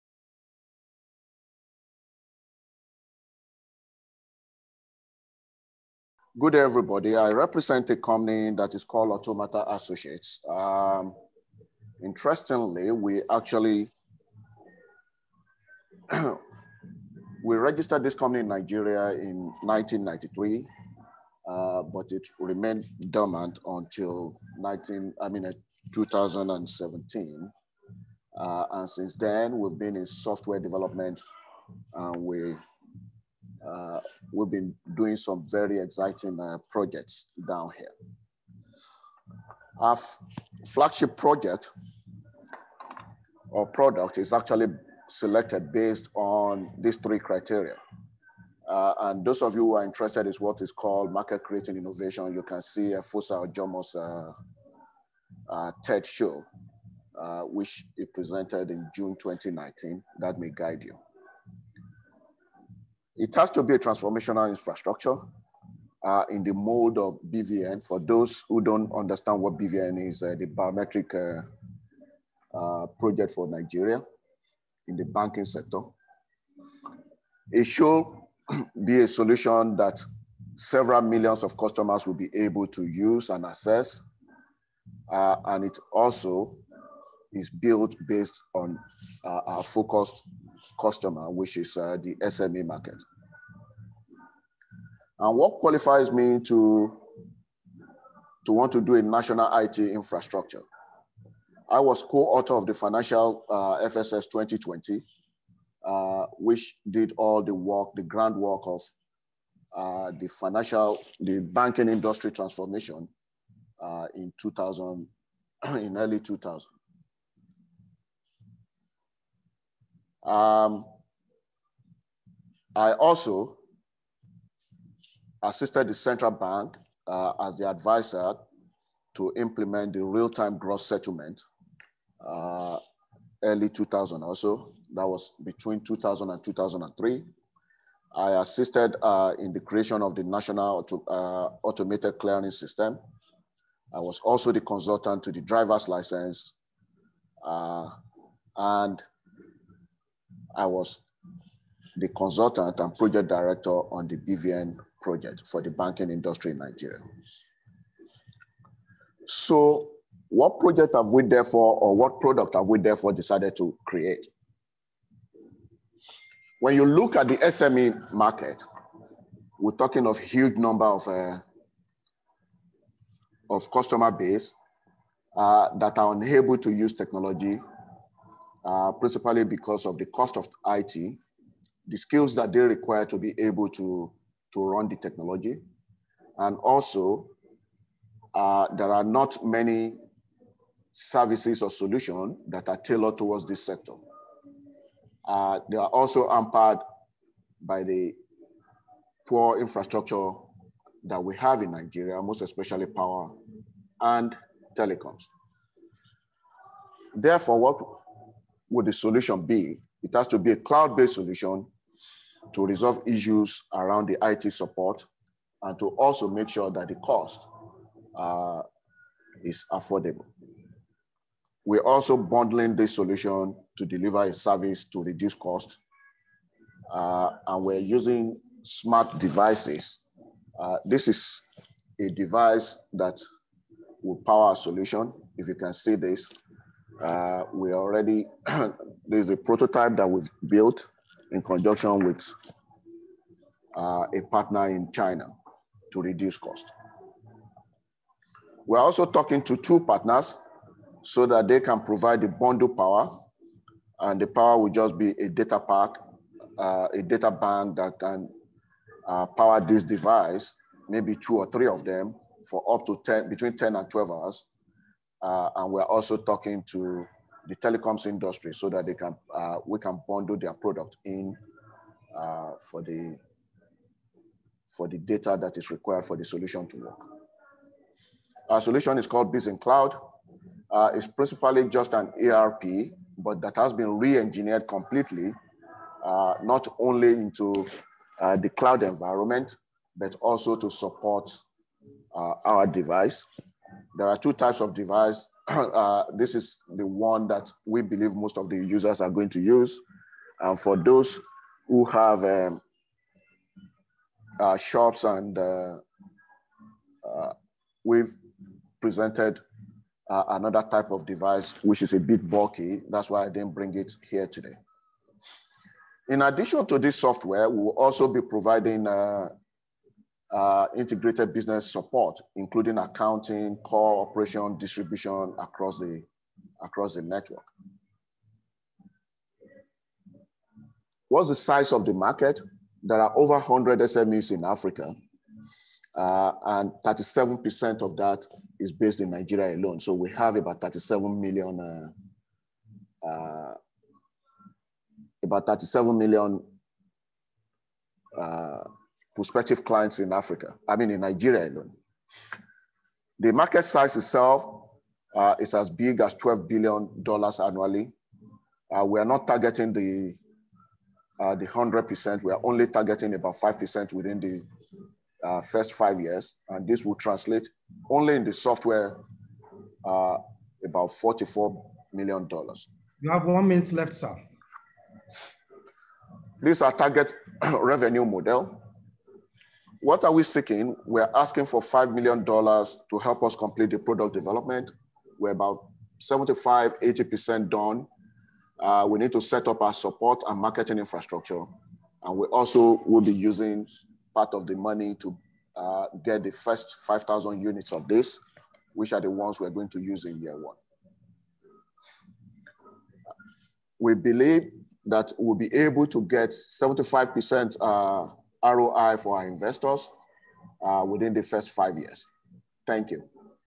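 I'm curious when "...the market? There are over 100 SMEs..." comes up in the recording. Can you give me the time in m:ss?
5:31.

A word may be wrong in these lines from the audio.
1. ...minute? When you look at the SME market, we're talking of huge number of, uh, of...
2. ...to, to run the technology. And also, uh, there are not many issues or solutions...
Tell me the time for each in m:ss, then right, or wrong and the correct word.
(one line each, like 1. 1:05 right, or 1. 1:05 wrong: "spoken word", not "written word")
1. 2:43 wrong: "create", not "minute"
2. 3:03 wrong: "services", not "issues".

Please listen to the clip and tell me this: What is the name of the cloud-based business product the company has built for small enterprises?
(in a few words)
Biz in Cloud.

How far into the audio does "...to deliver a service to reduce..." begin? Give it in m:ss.
3:43.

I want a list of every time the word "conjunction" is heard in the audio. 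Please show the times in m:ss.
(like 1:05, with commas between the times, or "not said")
4:01.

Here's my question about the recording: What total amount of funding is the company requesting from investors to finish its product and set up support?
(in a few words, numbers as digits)
$5 million.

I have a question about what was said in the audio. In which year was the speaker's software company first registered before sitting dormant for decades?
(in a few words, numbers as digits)
1993.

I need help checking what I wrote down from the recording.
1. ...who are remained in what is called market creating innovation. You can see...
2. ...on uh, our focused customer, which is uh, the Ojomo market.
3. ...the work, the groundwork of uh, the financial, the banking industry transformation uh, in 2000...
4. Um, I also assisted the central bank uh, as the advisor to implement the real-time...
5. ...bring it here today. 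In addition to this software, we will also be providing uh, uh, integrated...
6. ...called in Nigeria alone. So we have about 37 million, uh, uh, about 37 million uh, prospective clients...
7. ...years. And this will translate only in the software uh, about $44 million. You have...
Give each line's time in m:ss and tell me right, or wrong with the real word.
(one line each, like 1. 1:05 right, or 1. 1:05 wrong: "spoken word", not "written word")
1. 0:49 wrong: "interested", not "remained"
2. 1:28 wrong: "SME", not "Ojomo"
3. 1:47 right
4. 2:00 right
5. 5:13 right
6. 5:38 wrong: "based", not "called"
7. 6:05 right.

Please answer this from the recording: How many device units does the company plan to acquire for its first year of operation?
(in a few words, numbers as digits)
5,000.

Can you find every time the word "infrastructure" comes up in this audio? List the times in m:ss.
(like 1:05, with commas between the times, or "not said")
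1:04, 1:39, 3:19, 6:30.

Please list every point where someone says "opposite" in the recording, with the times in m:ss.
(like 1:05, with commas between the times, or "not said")
not said.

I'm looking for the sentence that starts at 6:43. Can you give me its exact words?
We believe that we'll be able to get 75% uh, ROI for our investors uh, within the first five years.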